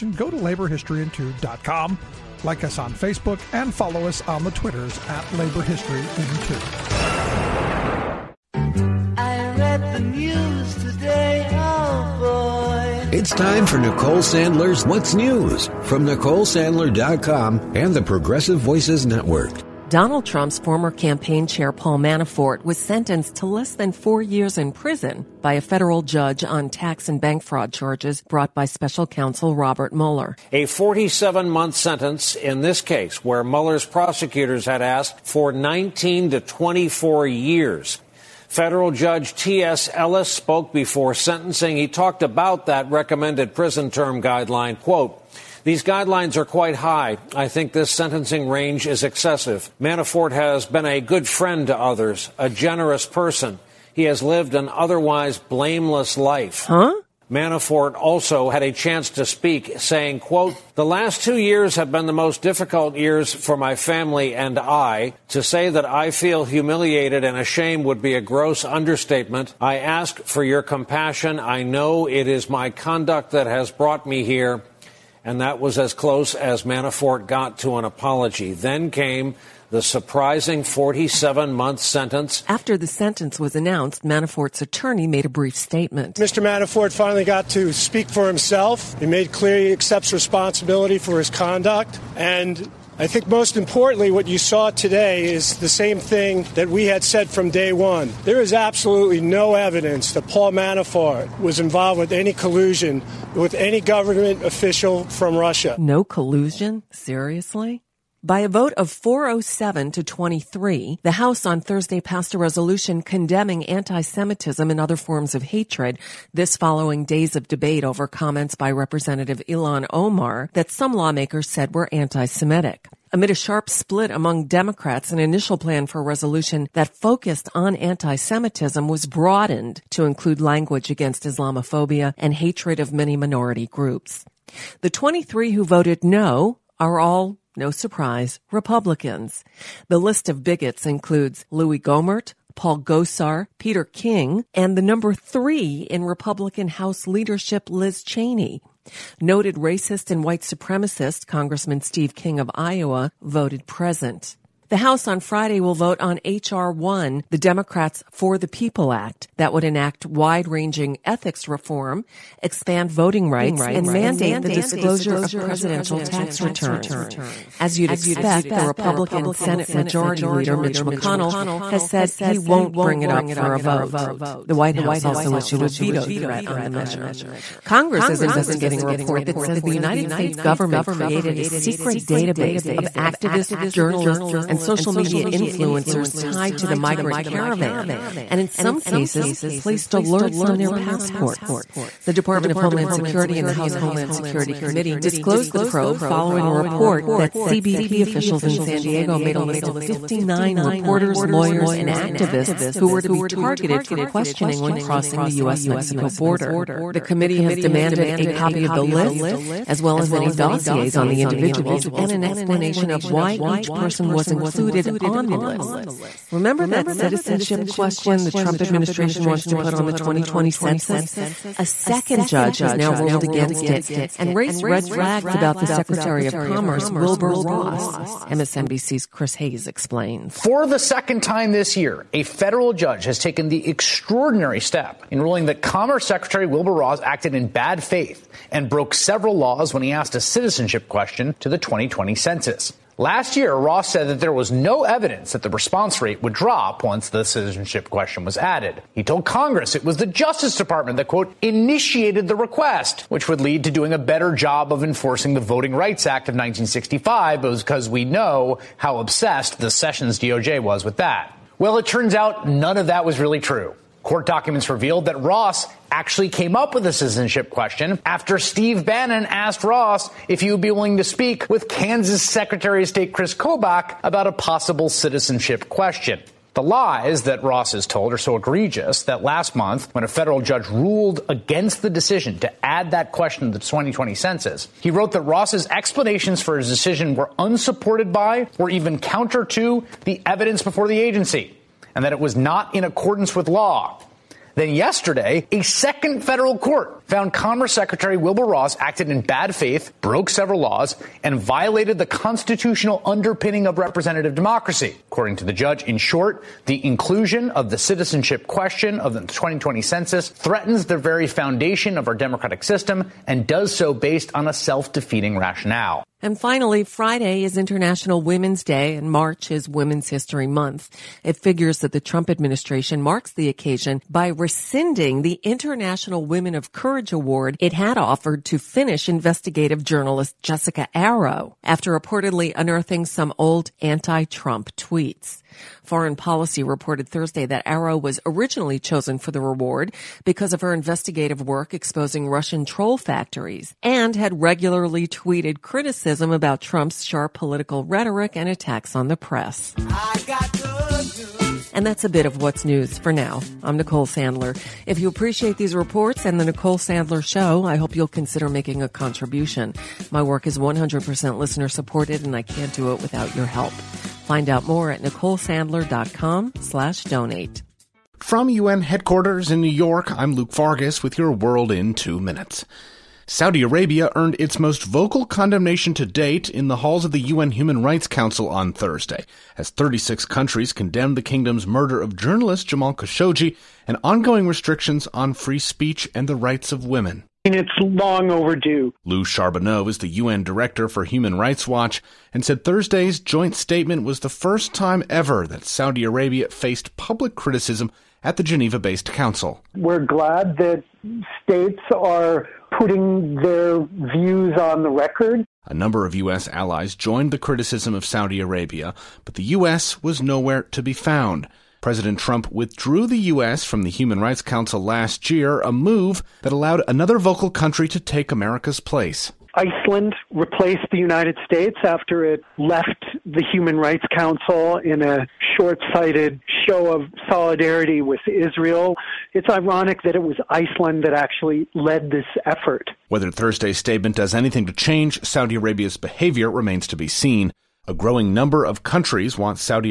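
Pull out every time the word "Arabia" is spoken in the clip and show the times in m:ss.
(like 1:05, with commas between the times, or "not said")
6:13, 6:36, 6:48, 7:15.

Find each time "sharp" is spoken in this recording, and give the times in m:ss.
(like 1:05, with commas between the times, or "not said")
2:03, 5:47.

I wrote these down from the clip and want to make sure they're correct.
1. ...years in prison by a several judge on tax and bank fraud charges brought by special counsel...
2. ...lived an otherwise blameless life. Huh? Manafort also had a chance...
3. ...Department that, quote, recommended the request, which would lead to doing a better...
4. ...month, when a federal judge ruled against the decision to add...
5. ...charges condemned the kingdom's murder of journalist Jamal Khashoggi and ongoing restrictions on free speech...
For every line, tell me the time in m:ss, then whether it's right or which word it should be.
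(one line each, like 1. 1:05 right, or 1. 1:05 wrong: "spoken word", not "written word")
1. 0:24 wrong: "federal", not "several"
2. 0:54 right
3. 4:10 wrong: "initiated", not "recommended"
4. 4:39 right
5. 6:20 wrong: "countries", not "charges".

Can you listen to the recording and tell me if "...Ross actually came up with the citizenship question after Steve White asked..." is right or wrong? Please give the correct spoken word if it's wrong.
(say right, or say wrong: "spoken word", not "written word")
wrong: "Bannon", not "White".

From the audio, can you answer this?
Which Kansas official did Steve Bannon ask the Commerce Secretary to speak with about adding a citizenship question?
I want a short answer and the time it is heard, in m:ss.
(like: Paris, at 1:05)
Chris Kobach, at 4:33.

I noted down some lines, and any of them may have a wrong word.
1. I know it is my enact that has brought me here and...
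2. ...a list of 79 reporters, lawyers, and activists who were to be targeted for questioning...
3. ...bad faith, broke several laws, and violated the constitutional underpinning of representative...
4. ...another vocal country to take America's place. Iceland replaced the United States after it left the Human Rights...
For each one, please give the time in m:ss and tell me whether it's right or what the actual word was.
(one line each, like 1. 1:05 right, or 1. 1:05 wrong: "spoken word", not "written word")
1. 1:11 wrong: "conduct", not "enact"
2. 3:19 wrong: "59", not "79"
3. 4:59 right
4. 6:56 right.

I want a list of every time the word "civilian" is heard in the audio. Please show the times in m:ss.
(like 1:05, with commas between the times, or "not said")
not said.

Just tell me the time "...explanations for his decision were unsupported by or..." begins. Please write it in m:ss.
4:45.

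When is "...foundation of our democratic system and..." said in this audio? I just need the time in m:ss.
5:11.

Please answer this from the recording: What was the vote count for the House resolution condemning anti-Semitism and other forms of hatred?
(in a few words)
407 to 23.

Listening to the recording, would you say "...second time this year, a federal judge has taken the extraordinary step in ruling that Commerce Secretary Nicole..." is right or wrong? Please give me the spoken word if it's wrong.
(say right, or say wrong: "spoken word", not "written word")
wrong: "Wilbur", not "Nicole".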